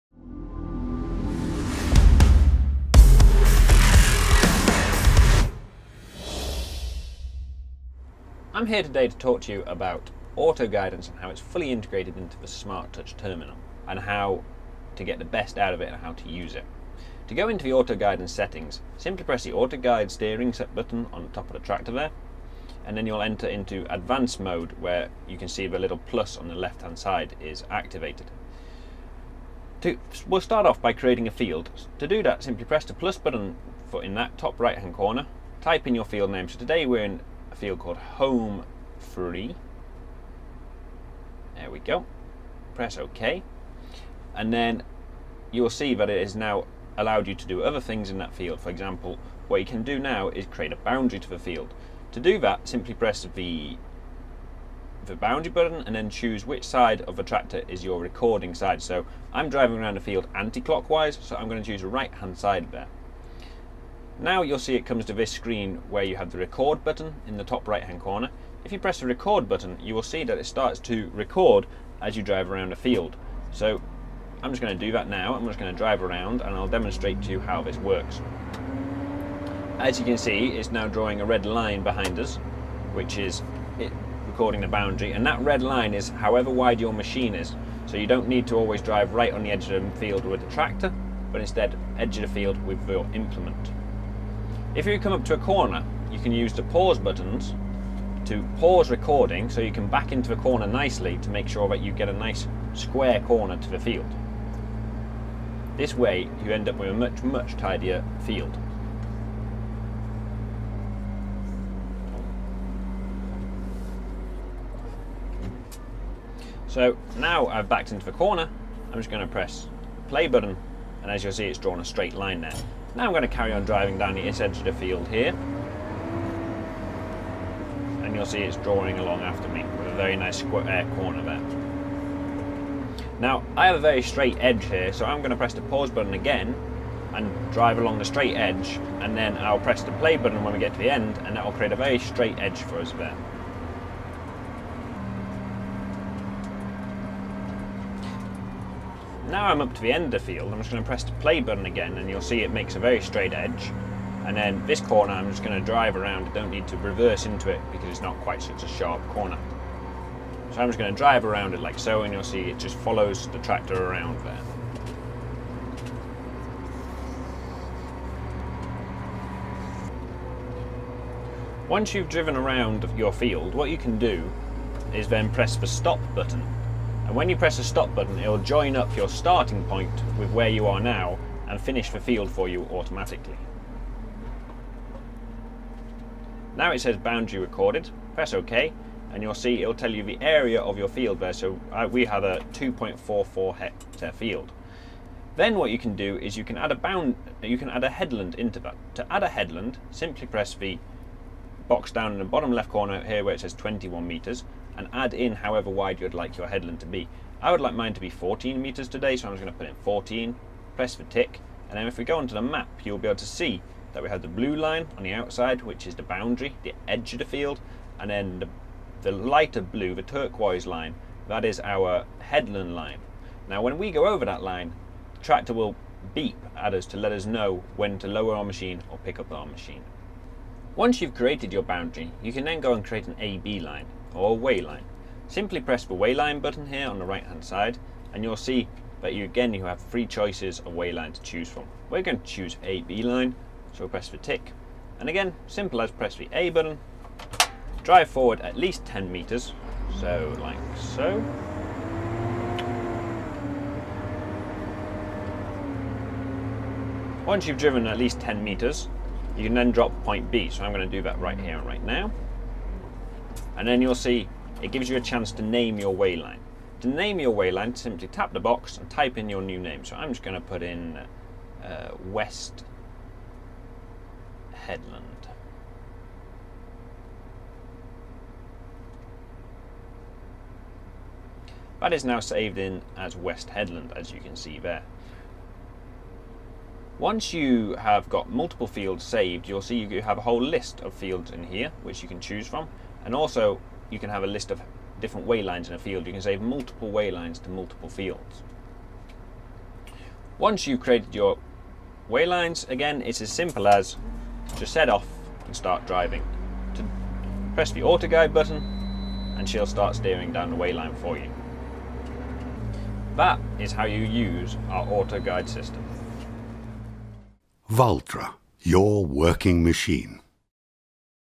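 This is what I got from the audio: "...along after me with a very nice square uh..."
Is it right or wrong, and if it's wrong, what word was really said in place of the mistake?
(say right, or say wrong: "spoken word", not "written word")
right.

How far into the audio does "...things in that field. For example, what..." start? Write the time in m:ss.
0:47.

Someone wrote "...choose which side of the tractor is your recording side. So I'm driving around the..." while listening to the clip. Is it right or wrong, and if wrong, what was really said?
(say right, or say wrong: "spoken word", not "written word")
right.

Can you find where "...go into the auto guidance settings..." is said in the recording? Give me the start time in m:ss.
0:17.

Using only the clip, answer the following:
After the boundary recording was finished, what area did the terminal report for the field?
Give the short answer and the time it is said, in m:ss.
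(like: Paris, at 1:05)
2.44 hectares, at 3:12.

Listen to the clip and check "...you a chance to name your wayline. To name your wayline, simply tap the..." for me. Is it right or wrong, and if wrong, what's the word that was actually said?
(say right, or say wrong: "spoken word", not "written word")
right.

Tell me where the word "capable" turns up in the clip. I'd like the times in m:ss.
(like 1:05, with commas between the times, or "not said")
not said.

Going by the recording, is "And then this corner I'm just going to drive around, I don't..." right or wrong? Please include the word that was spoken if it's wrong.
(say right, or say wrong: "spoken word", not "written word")
right.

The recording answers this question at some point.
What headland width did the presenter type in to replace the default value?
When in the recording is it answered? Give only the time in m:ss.
3:28.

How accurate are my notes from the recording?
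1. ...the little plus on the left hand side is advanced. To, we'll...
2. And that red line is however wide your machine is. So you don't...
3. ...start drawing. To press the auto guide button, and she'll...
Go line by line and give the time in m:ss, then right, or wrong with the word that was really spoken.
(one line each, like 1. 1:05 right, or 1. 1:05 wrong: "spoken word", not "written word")
1. 0:25 wrong: "activated", not "advanced"
2. 1:25 right
3. 5:05 wrong: "driving", not "drawing".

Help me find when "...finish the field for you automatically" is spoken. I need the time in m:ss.
3:01.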